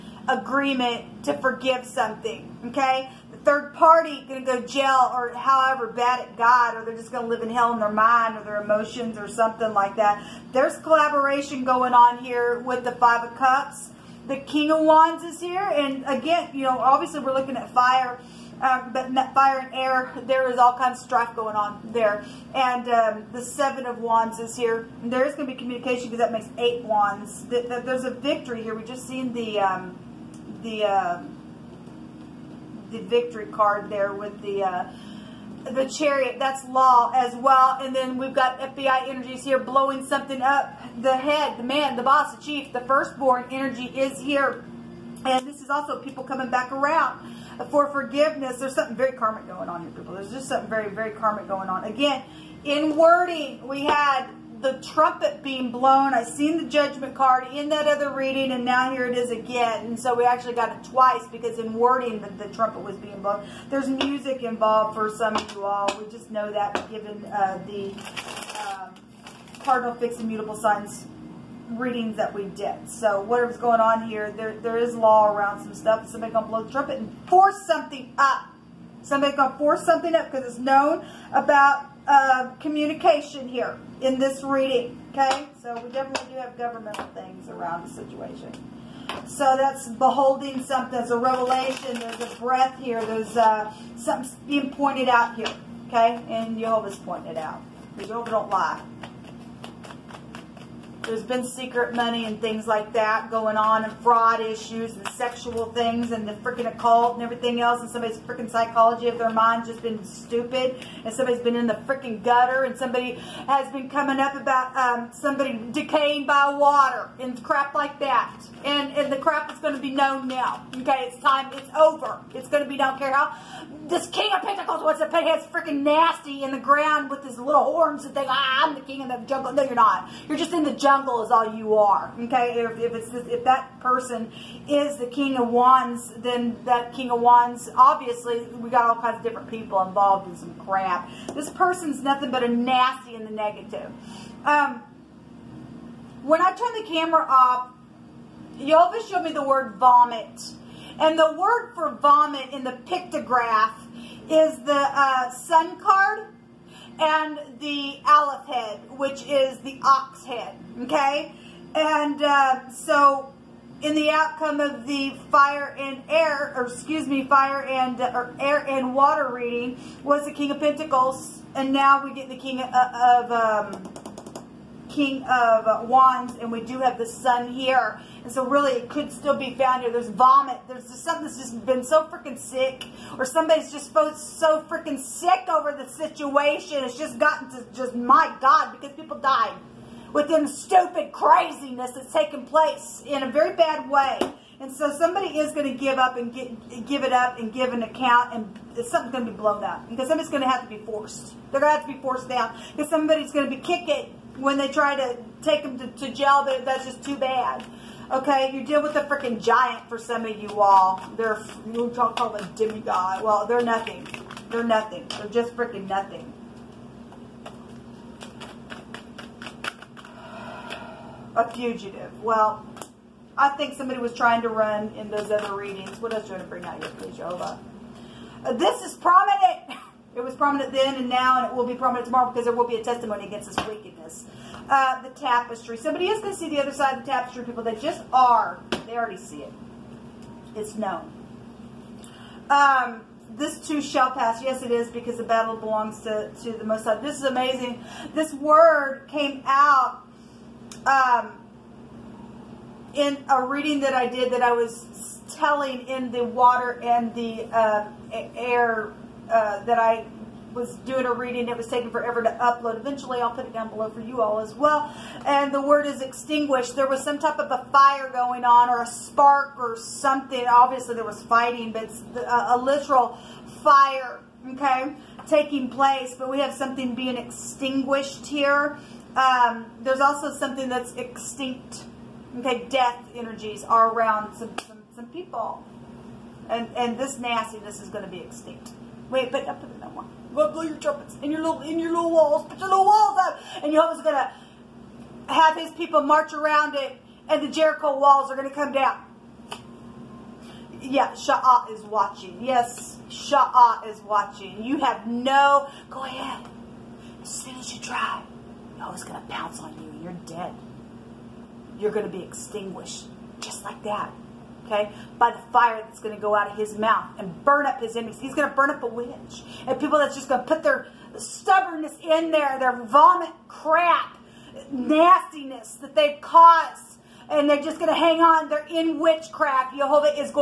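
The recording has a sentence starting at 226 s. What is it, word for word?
What else do you want to bring out here, please, Jehovah?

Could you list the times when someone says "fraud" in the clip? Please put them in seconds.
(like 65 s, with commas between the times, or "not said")
103 s.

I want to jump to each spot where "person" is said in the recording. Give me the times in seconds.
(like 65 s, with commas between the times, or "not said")
133 s, 141 s.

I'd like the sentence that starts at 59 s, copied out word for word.
And so we actually got it twice because in wording, the, the trumpet was being blown.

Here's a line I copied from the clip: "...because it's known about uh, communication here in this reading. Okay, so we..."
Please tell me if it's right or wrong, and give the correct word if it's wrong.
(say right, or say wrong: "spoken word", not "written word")
right.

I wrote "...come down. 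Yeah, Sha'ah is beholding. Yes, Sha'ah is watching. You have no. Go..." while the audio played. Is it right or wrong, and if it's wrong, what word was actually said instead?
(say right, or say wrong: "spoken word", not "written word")
wrong: "watching", not "beholding".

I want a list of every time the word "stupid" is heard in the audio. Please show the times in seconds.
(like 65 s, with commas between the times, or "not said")
110 s, 190 s.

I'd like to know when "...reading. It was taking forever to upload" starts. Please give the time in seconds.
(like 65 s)
261 s.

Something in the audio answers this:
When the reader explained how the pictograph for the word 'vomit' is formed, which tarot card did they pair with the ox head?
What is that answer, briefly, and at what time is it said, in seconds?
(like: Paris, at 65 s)
The Sun, at 154 s.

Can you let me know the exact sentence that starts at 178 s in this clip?
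And so really it could still be found here.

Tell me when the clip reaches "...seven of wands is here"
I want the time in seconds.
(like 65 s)
23 s.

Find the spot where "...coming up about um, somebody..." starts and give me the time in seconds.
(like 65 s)
113 s.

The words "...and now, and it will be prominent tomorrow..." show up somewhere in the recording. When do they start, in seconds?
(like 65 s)
230 s.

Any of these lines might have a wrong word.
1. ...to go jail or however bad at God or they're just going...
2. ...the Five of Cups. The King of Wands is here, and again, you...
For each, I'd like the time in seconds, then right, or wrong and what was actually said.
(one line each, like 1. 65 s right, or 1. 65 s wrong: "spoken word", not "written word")
1. 4 s right
2. 12 s right.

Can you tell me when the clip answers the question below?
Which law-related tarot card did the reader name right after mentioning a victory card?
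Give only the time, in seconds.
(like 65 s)
35 s.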